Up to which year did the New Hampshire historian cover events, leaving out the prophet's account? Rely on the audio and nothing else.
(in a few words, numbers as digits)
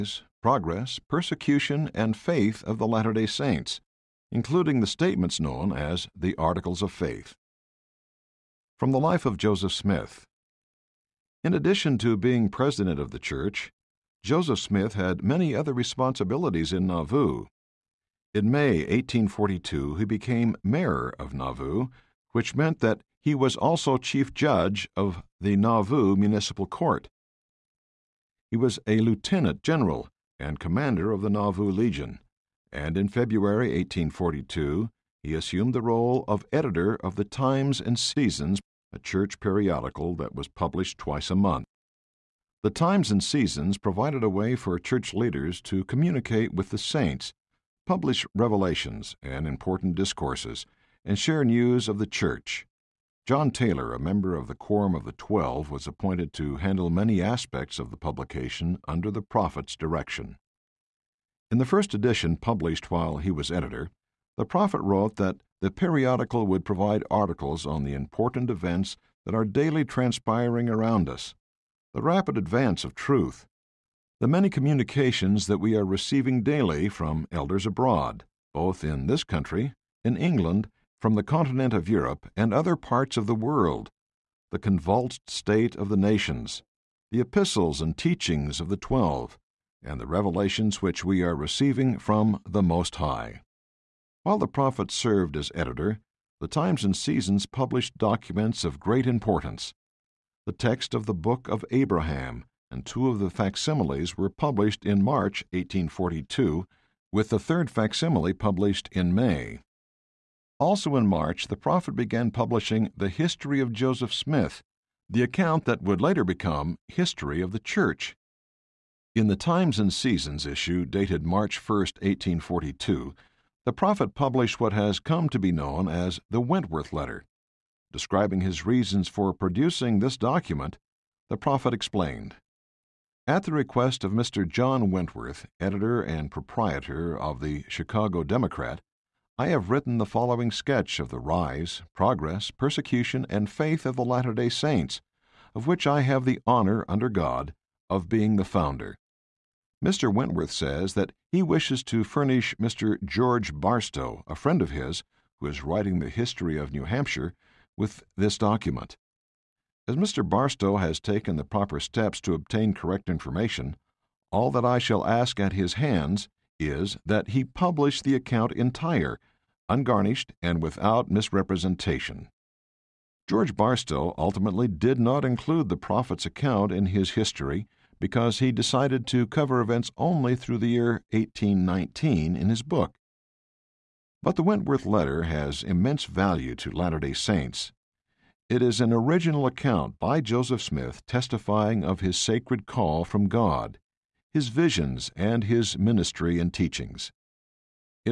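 1819.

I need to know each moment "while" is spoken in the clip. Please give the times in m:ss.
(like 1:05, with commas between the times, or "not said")
1:02, 1:34.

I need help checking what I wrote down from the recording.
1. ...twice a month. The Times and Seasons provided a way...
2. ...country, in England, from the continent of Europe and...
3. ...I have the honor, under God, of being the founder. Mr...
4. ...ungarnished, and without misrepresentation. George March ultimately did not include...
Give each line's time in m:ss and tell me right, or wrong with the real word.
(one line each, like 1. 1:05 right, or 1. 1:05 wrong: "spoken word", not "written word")
1. 0:40 right
2. 1:19 right
3. 2:25 right
4. 2:49 wrong: "Barstow", not "March".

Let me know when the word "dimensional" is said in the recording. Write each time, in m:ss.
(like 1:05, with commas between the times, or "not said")
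not said.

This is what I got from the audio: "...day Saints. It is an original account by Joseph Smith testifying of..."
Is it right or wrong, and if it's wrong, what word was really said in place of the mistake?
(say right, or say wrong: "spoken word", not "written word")
right.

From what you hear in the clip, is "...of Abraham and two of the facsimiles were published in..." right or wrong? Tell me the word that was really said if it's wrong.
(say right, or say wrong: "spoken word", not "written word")
right.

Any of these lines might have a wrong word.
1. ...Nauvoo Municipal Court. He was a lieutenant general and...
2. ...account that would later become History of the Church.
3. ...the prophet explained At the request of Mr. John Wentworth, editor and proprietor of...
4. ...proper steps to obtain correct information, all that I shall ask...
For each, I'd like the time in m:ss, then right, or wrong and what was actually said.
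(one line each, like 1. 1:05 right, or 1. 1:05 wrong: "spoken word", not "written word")
1. 0:25 right
2. 1:55 right
3. 2:11 right
4. 2:41 right.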